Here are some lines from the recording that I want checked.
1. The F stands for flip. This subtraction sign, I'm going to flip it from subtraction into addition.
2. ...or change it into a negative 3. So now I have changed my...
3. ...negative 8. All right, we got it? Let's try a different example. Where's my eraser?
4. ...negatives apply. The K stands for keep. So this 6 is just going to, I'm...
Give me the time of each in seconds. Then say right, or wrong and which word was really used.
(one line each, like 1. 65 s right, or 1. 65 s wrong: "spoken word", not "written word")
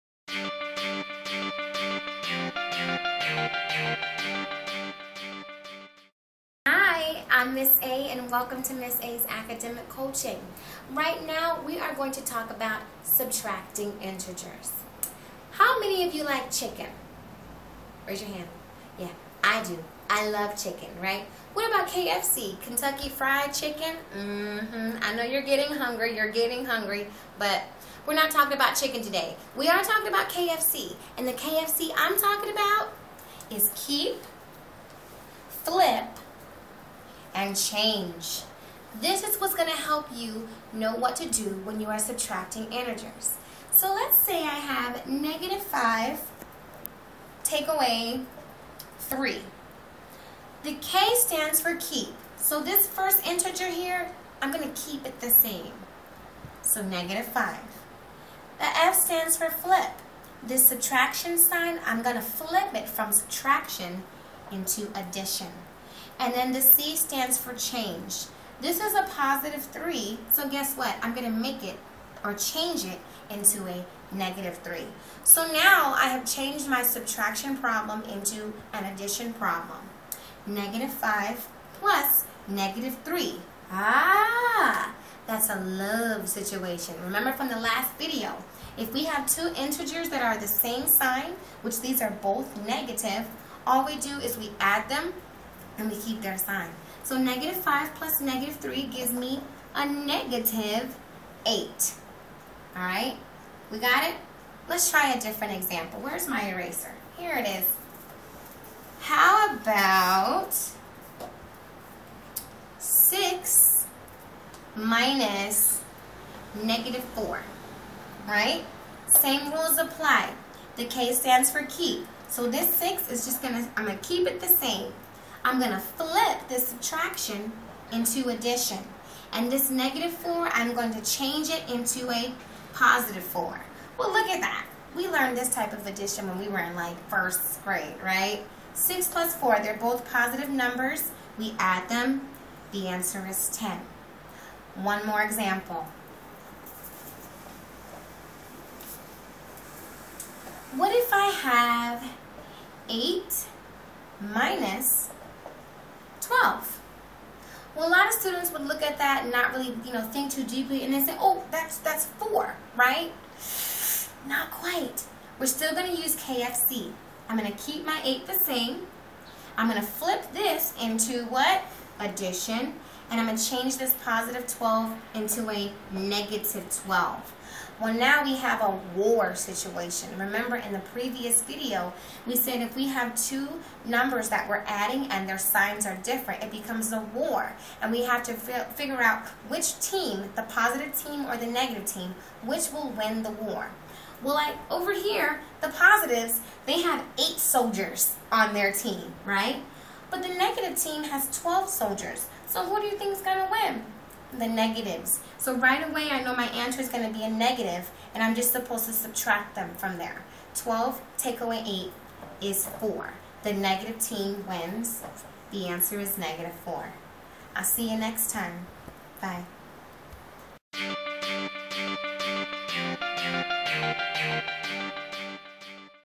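1. 58 s right
2. 72 s right
3. 99 s right
4. 119 s wrong: "rules", not "negatives".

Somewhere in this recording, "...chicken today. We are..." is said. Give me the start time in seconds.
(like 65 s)
28 s.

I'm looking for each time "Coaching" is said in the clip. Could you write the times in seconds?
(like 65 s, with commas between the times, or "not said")
9 s.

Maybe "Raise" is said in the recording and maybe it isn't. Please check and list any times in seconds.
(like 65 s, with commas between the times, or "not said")
18 s.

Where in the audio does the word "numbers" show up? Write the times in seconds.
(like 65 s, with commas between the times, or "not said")
140 s, 183 s.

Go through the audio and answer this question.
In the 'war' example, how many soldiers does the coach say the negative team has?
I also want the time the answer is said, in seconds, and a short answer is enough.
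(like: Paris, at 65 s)
12, at 201 s.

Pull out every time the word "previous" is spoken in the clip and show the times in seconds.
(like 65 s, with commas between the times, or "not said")
180 s.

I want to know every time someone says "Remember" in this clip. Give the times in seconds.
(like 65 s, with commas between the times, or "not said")
87 s, 180 s.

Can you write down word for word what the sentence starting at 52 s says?
So this first integer here, I'm going to keep it the same.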